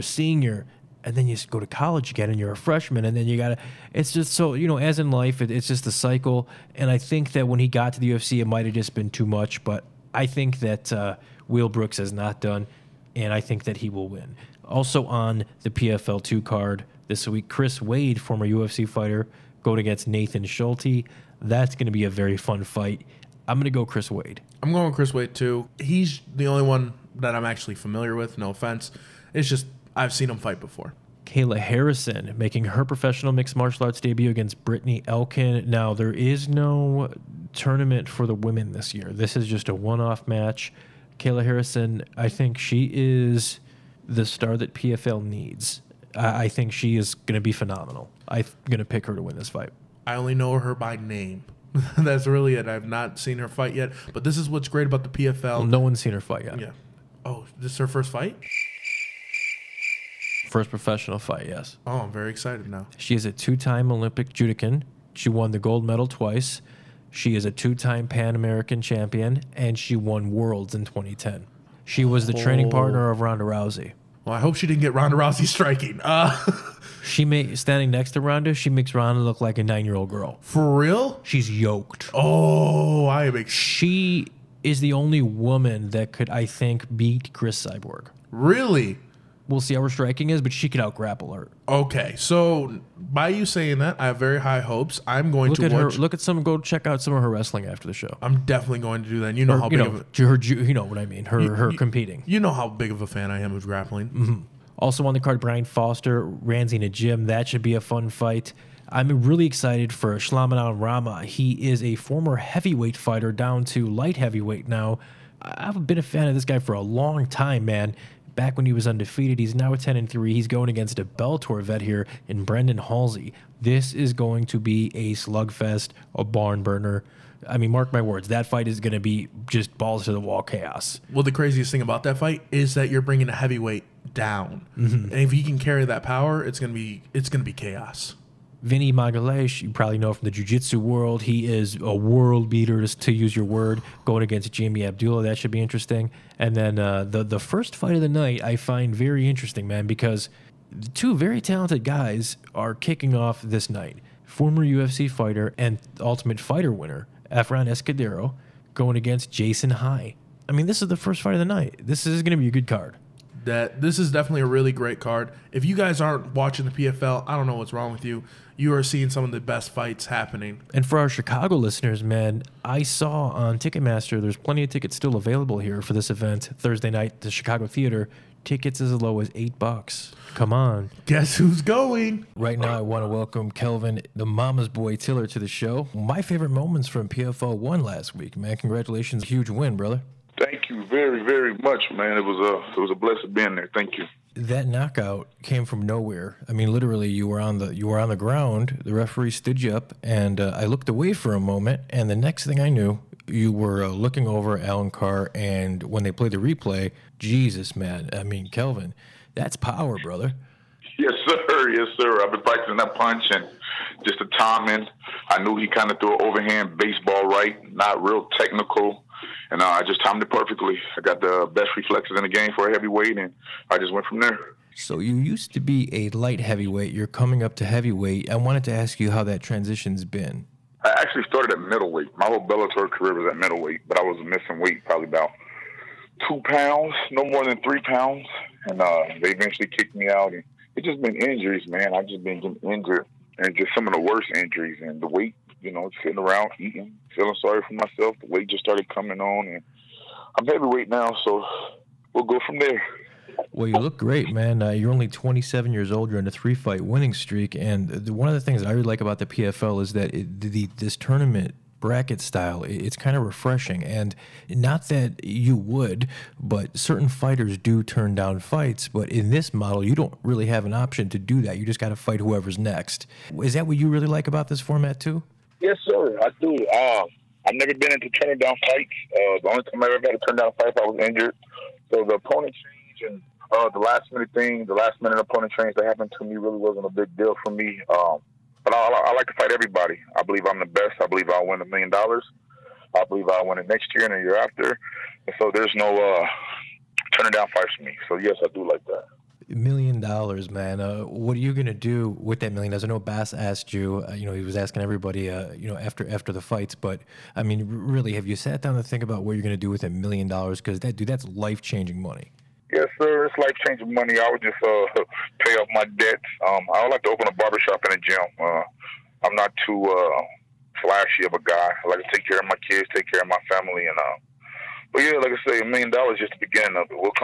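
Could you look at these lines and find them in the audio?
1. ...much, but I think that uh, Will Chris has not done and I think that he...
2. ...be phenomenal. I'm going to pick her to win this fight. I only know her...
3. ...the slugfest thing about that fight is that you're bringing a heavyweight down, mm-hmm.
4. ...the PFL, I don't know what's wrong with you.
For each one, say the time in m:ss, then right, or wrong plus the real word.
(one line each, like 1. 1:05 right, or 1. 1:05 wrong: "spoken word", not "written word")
1. 0:09 wrong: "Brooks", not "Chris"
2. 0:47 right
3. 2:11 wrong: "craziest", not "slugfest"
4. 2:46 right.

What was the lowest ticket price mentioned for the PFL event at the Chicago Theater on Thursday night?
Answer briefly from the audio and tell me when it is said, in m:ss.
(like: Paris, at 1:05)
$8, at 2:59.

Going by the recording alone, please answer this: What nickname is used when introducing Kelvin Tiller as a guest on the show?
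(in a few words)
The Mama's Boy.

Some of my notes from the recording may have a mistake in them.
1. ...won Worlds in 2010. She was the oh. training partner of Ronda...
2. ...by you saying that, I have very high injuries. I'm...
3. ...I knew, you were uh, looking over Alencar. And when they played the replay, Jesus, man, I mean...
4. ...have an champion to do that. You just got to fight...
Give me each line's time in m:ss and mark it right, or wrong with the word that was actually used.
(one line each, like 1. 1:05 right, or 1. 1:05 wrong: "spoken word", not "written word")
1. 1:09 right
2. 1:32 wrong: "hopes", not "injuries"
3. 3:22 right
4. 4:30 wrong: "option", not "champion".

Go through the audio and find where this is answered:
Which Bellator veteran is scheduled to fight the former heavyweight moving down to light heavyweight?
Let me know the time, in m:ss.
2:02.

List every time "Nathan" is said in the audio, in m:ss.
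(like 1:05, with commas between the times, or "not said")
0:20.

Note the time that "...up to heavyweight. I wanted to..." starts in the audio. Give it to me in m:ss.
3:47.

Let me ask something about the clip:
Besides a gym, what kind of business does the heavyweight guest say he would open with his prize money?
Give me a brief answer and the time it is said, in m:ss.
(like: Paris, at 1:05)
A barbershop, at 5:17.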